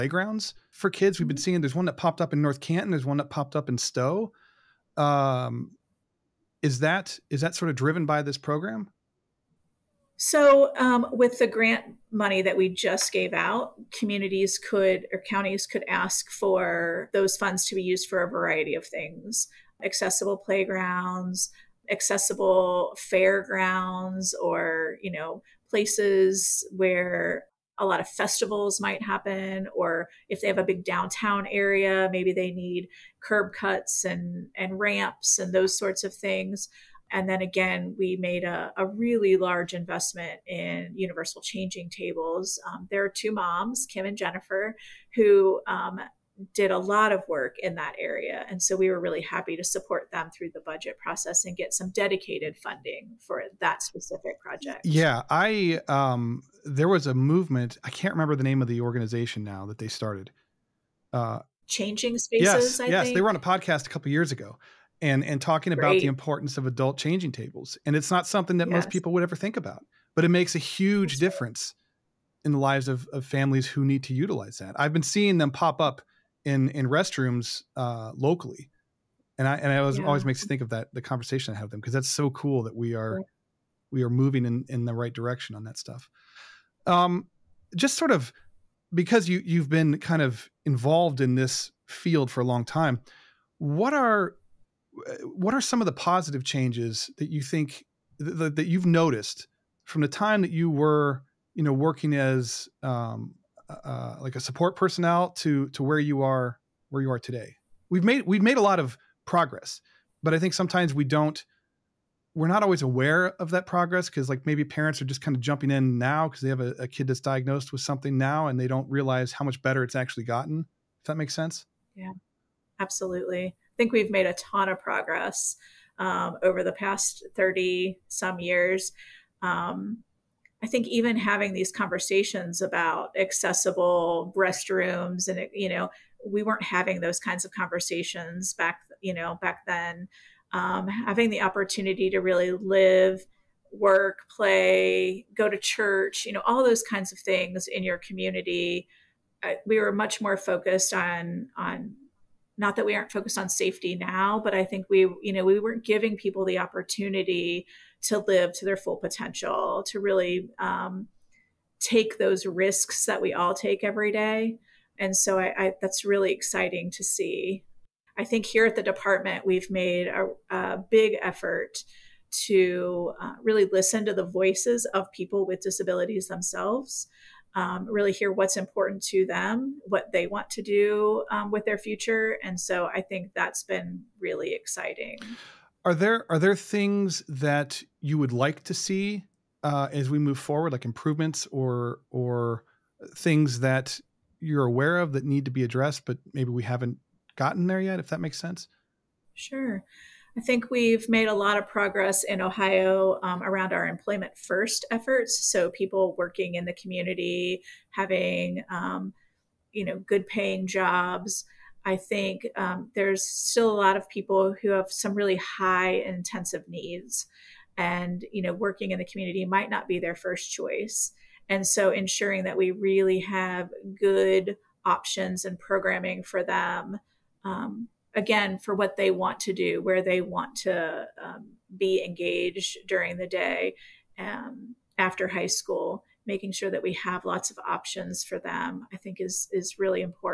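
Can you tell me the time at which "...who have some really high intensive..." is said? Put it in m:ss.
3:34.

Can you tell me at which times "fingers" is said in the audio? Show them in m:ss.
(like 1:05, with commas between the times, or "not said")
not said.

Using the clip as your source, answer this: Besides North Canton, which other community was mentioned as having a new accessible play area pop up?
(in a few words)
Stow.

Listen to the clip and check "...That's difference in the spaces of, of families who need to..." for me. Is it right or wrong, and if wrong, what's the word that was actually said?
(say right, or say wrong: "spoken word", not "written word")
wrong: "lives", not "spaces".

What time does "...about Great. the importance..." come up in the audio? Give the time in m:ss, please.
1:05.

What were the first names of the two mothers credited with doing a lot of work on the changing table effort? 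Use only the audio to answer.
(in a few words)
Kim and Jennifer.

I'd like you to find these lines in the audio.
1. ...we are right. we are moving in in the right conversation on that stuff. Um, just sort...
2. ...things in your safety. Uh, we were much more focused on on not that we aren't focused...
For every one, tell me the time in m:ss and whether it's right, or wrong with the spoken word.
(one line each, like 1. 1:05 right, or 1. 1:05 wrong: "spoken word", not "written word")
1. 1:22 wrong: "direction", not "conversation"
2. 2:27 wrong: "community", not "safety".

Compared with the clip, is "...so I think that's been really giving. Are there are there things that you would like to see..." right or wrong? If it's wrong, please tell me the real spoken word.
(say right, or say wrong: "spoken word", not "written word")
wrong: "exciting", not "giving".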